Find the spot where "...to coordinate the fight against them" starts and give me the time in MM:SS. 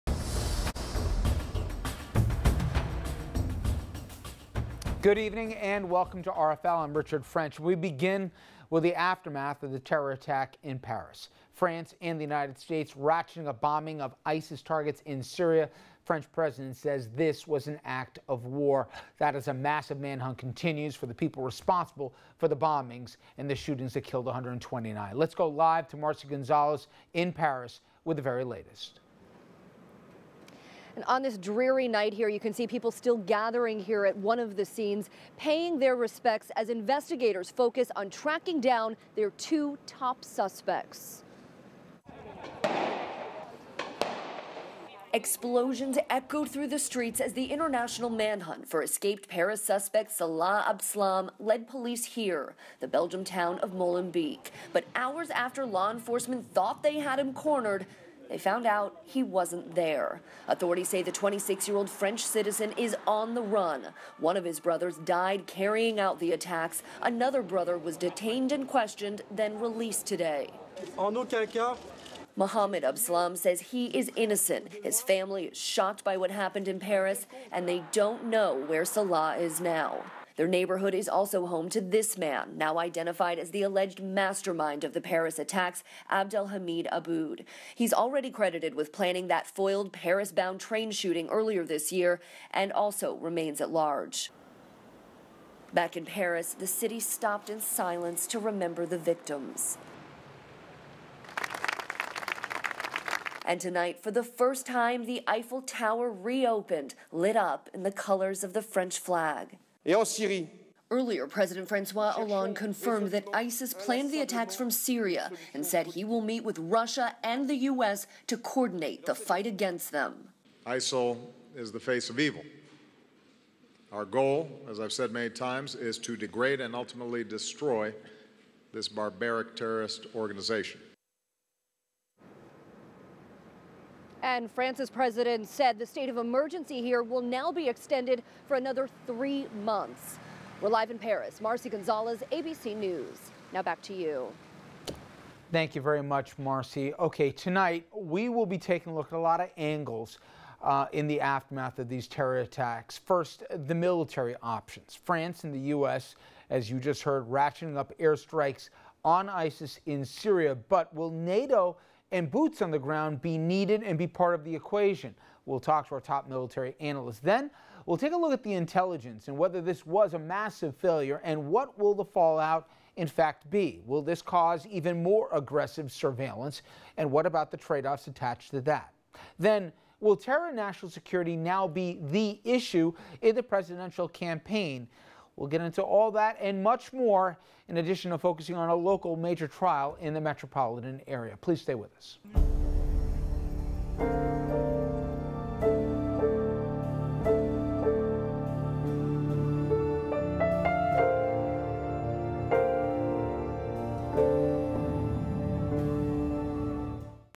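01:58.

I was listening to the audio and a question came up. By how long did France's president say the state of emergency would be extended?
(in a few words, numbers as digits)
3 months.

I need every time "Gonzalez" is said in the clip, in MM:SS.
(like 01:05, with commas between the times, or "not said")
00:26, 02:21.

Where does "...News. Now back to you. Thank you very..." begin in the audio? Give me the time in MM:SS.
02:22.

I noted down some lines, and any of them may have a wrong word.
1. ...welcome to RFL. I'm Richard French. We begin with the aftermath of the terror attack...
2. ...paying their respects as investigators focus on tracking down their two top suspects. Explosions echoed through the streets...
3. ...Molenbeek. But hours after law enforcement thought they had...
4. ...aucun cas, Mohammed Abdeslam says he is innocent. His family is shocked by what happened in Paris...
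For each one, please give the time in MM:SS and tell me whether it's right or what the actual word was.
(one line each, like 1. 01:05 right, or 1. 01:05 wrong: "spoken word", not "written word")
1. 00:05 right
2. 00:35 right
3. 00:53 right
4. 01:11 right.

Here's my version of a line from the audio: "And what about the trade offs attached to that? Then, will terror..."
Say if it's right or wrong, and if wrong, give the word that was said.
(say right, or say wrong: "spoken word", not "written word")
right.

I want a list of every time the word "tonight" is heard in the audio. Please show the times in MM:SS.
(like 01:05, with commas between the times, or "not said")
01:43, 02:27.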